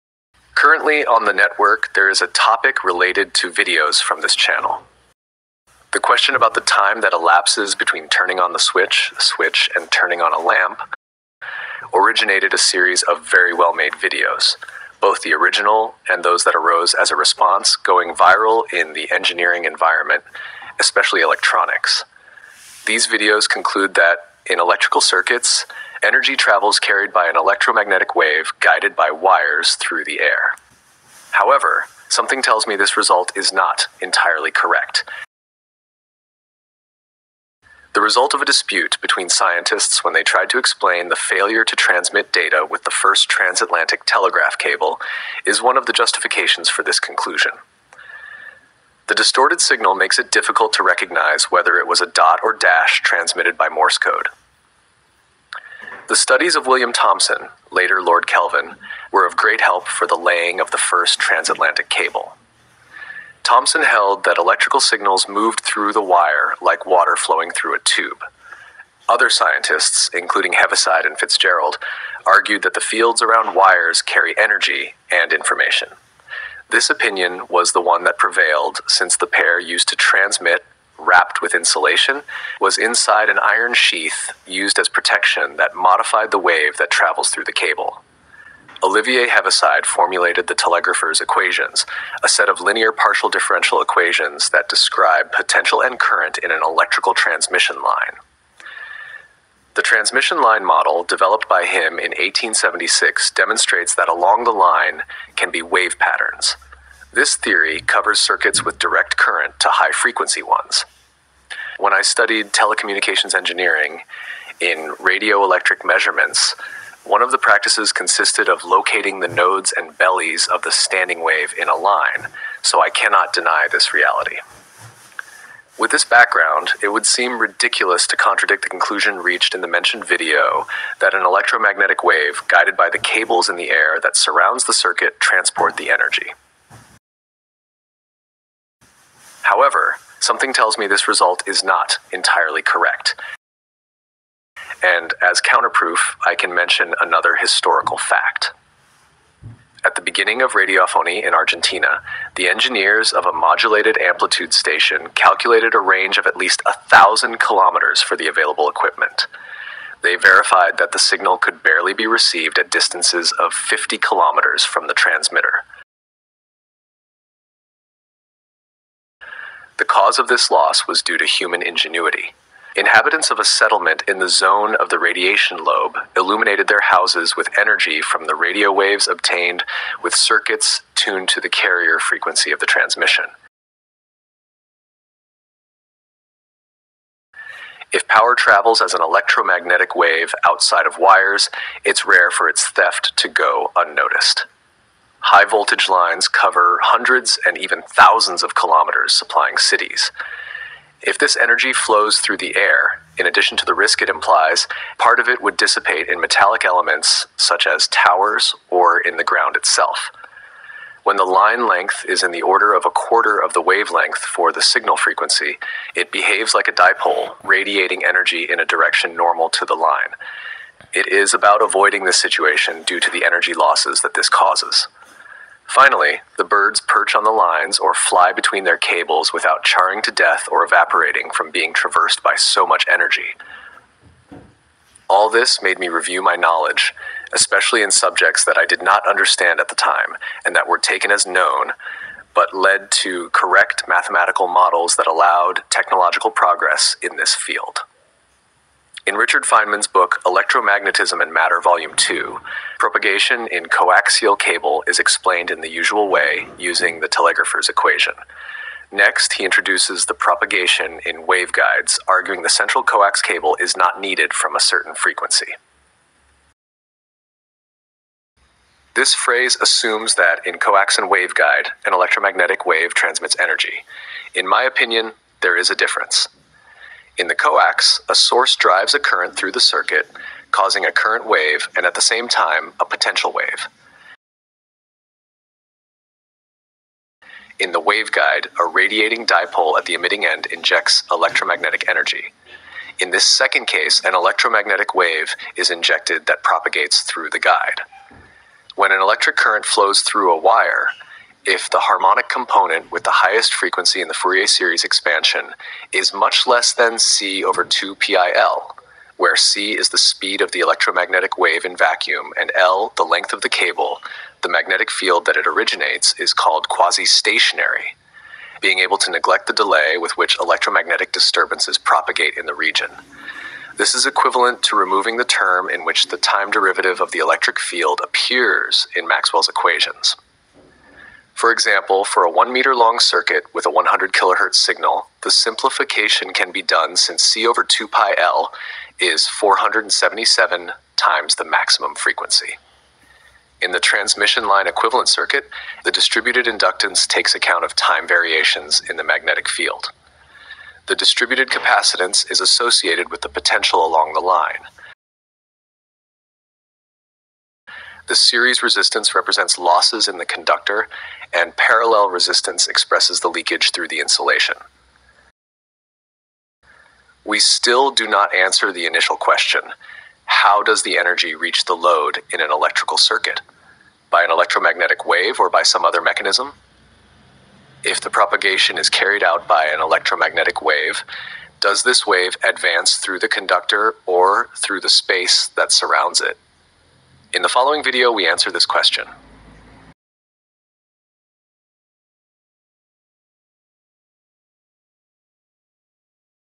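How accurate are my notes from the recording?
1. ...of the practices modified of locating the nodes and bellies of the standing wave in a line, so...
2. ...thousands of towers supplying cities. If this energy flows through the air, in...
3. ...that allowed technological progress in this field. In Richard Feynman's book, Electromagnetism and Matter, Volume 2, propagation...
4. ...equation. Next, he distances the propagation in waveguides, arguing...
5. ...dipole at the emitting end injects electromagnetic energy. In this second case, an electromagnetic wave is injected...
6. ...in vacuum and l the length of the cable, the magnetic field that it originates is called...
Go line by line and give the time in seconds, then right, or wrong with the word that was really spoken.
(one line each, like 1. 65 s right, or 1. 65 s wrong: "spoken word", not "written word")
1. 117 s wrong: "consisted", not "modified"
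2. 197 s wrong: "kilometers", not "towers"
3. 244 s right
4. 257 s wrong: "introduces", not "distances"
5. 289 s right
6. 311 s right.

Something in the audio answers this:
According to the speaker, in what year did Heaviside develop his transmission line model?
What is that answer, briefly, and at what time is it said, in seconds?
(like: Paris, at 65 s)
1876, at 102 s.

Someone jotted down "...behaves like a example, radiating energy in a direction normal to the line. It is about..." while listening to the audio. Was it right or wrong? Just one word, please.
wrong.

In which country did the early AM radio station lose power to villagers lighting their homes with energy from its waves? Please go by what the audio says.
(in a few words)
Argentina.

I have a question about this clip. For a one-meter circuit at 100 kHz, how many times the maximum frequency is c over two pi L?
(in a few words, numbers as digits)
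477.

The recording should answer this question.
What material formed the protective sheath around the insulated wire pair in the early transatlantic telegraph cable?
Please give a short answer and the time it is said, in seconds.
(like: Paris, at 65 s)
iron, at 83 s.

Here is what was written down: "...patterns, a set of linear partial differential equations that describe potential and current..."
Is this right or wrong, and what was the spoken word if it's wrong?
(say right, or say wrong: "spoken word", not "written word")
wrong: "equations", not "patterns".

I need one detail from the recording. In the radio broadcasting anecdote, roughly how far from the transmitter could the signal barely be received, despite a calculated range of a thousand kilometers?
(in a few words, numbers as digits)
50 kilometers.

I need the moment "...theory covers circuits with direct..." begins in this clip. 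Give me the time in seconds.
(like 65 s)
107 s.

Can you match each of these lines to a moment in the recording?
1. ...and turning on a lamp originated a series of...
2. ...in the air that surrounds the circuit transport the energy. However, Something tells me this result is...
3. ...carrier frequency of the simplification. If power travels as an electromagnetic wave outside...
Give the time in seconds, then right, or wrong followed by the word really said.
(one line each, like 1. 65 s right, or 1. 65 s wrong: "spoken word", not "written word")
1. 9 s right
2. 133 s right
3. 181 s wrong: "transmission", not "simplification".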